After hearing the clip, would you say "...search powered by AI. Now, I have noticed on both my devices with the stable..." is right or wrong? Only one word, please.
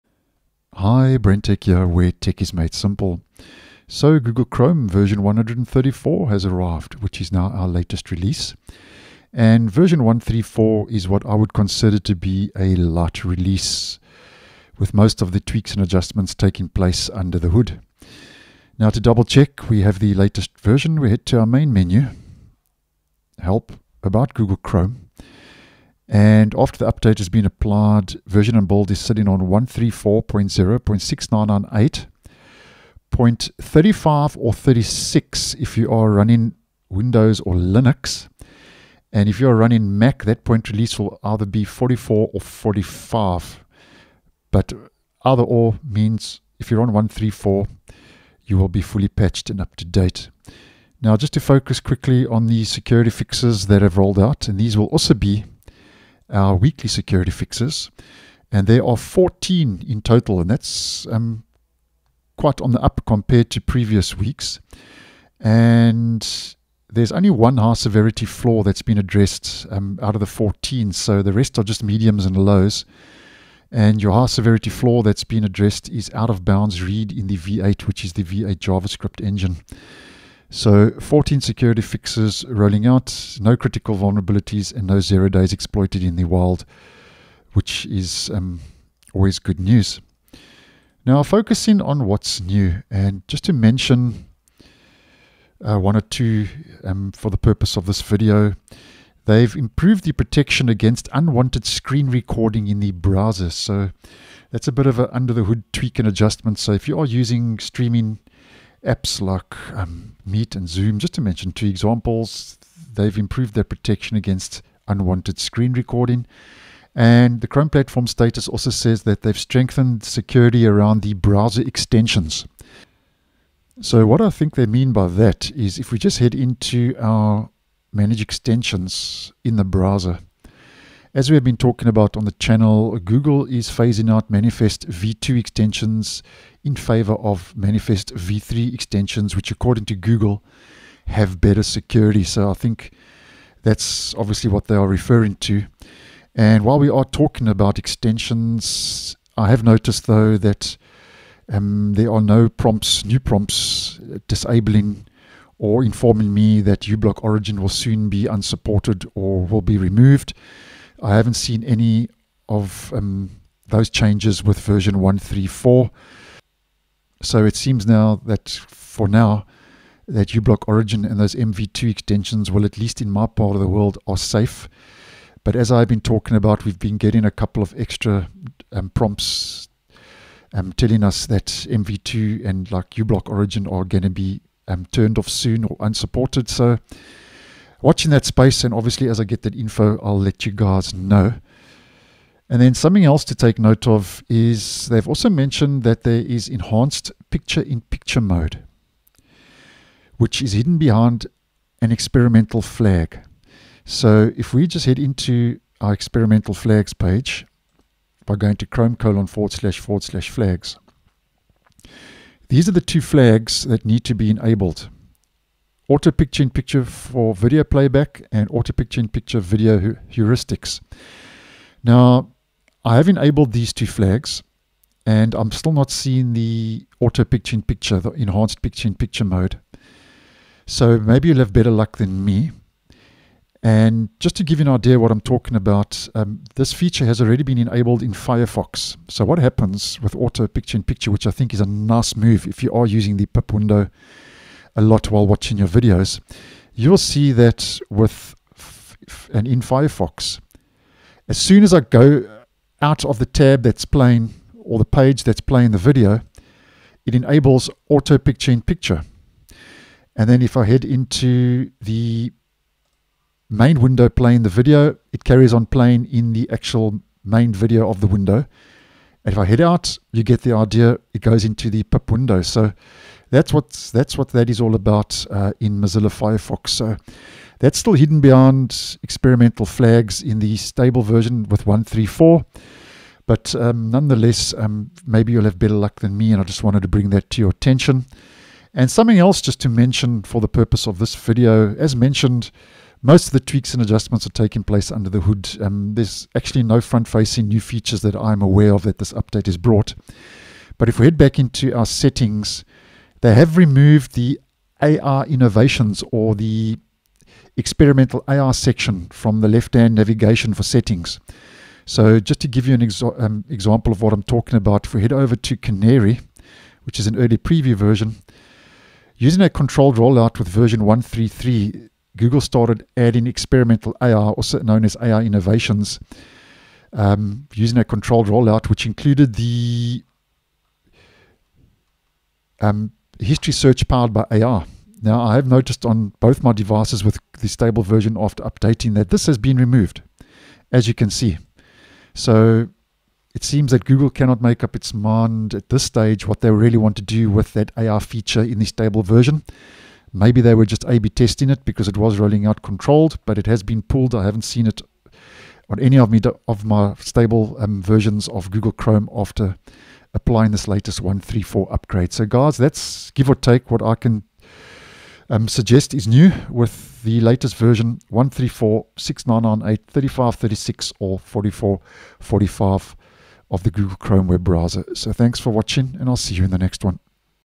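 right.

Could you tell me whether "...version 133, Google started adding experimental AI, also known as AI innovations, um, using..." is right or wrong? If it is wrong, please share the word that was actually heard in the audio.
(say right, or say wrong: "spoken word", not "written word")
right.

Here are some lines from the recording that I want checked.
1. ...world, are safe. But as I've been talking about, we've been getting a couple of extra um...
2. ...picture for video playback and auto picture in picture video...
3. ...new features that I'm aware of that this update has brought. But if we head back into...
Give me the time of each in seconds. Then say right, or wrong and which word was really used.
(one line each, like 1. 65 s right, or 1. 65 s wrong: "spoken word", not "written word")
1. 173 s right
2. 216 s right
3. 297 s right.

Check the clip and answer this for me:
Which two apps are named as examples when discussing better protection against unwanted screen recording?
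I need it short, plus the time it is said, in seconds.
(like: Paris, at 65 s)
Meet and Zoom, at 110 s.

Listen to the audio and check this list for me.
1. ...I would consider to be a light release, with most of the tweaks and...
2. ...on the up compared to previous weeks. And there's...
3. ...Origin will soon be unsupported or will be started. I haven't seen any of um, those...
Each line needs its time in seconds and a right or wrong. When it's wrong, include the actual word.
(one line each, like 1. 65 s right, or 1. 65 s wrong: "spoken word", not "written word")
1. 11 s right
2. 62 s right
3. 157 s wrong: "removed", not "started".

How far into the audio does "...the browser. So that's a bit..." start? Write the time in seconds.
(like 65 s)
102 s.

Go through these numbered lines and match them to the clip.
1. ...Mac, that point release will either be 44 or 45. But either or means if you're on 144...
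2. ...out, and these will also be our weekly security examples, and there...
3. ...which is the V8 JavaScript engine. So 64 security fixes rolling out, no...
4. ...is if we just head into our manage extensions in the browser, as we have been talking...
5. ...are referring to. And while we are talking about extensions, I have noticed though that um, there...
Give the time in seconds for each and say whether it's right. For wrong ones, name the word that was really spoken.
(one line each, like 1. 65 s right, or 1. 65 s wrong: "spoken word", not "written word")
1. 39 s wrong: "134", not "144"
2. 54 s wrong: "fixes", not "examples"
3. 77 s wrong: "14", not "64"
4. 125 s right
5. 144 s right.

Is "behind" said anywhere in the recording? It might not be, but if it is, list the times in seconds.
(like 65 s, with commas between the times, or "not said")
200 s, 278 s.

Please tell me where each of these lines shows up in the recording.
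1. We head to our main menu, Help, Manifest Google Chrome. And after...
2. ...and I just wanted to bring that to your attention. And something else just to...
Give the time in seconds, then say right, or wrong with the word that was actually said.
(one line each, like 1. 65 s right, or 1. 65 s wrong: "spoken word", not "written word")
1. 20 s wrong: "About", not "Manifest"
2. 286 s right.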